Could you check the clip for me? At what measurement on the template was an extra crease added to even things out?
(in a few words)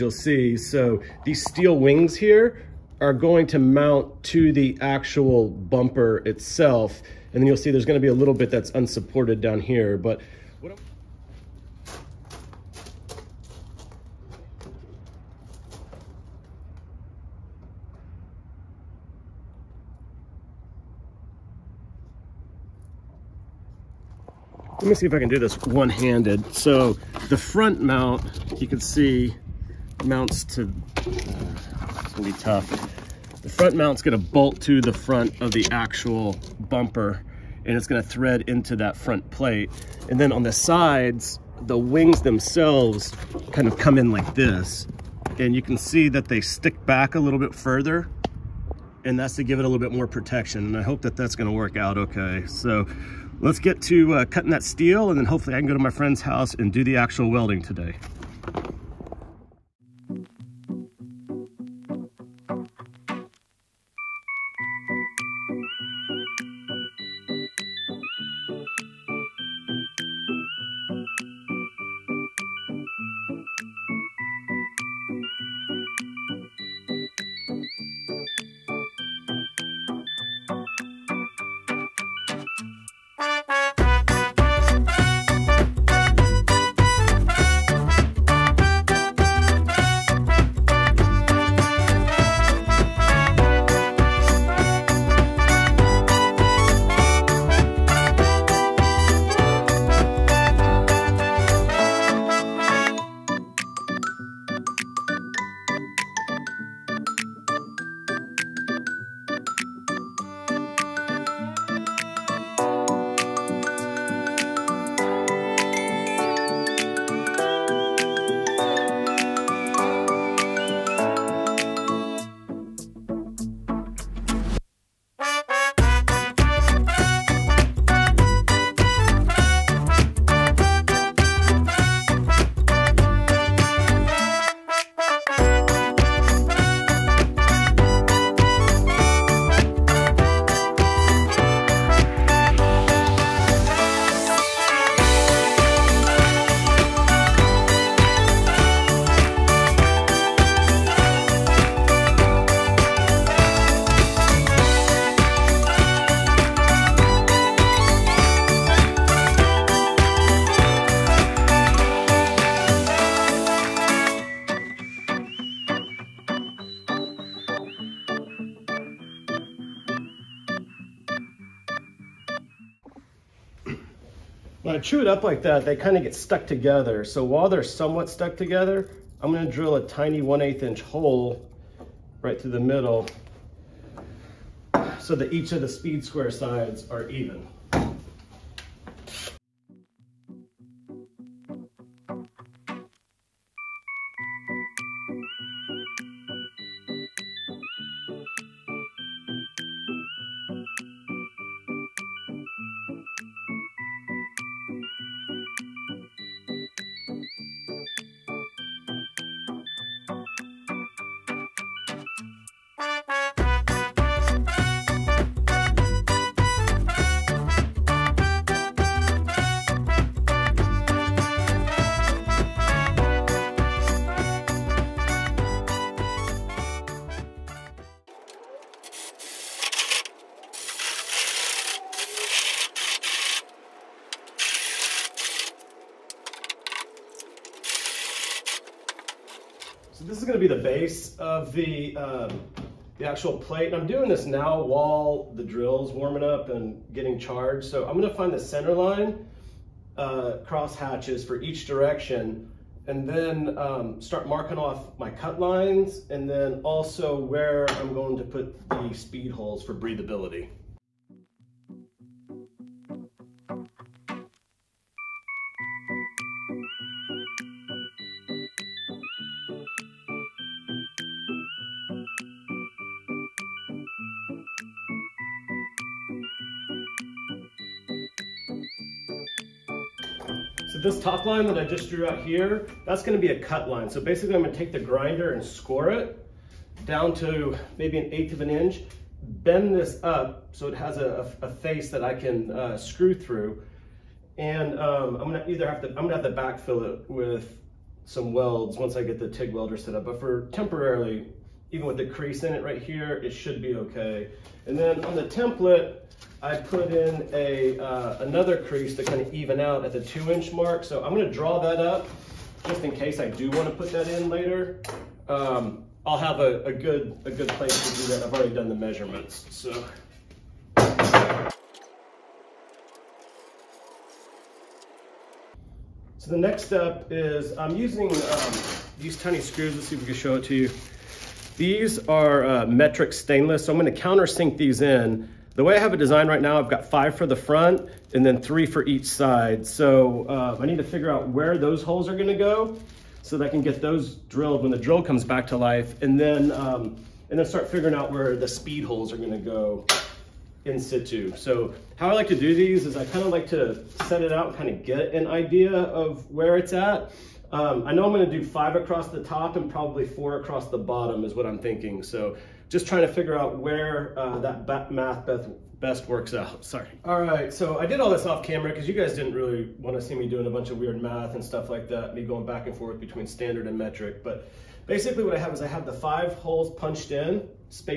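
2 inch mark.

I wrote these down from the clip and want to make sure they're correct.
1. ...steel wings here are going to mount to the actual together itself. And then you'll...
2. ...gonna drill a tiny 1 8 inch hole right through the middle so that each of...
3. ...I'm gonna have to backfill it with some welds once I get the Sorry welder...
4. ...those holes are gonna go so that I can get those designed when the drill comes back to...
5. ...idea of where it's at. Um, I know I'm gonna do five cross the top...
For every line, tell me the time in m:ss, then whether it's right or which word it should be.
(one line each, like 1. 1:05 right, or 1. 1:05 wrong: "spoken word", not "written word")
1. 0:01 wrong: "bumper", not "together"
2. 2:59 right
3. 4:55 wrong: "TIG", not "Sorry"
4. 5:41 wrong: "drilled", not "designed"
5. 5:55 wrong: "across", not "cross".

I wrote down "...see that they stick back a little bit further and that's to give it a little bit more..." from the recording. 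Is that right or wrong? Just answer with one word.
right.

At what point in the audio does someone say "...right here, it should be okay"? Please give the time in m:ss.
5:02.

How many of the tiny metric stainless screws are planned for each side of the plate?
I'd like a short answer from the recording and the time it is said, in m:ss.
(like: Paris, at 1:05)
3, at 5:38.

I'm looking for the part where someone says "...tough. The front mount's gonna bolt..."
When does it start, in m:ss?
0:32.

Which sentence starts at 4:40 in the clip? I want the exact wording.
So this top line that I just drew out here, that's gonna be a cut line.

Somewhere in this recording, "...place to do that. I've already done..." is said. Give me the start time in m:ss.
5:17.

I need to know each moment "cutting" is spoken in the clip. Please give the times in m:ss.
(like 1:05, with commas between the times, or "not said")
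0:54.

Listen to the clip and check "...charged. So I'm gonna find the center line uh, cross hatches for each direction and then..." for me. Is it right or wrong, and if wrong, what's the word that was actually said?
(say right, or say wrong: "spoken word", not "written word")
right.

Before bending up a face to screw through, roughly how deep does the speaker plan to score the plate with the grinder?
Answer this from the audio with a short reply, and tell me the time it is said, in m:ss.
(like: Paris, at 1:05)
an eighth of an inch, at 4:47.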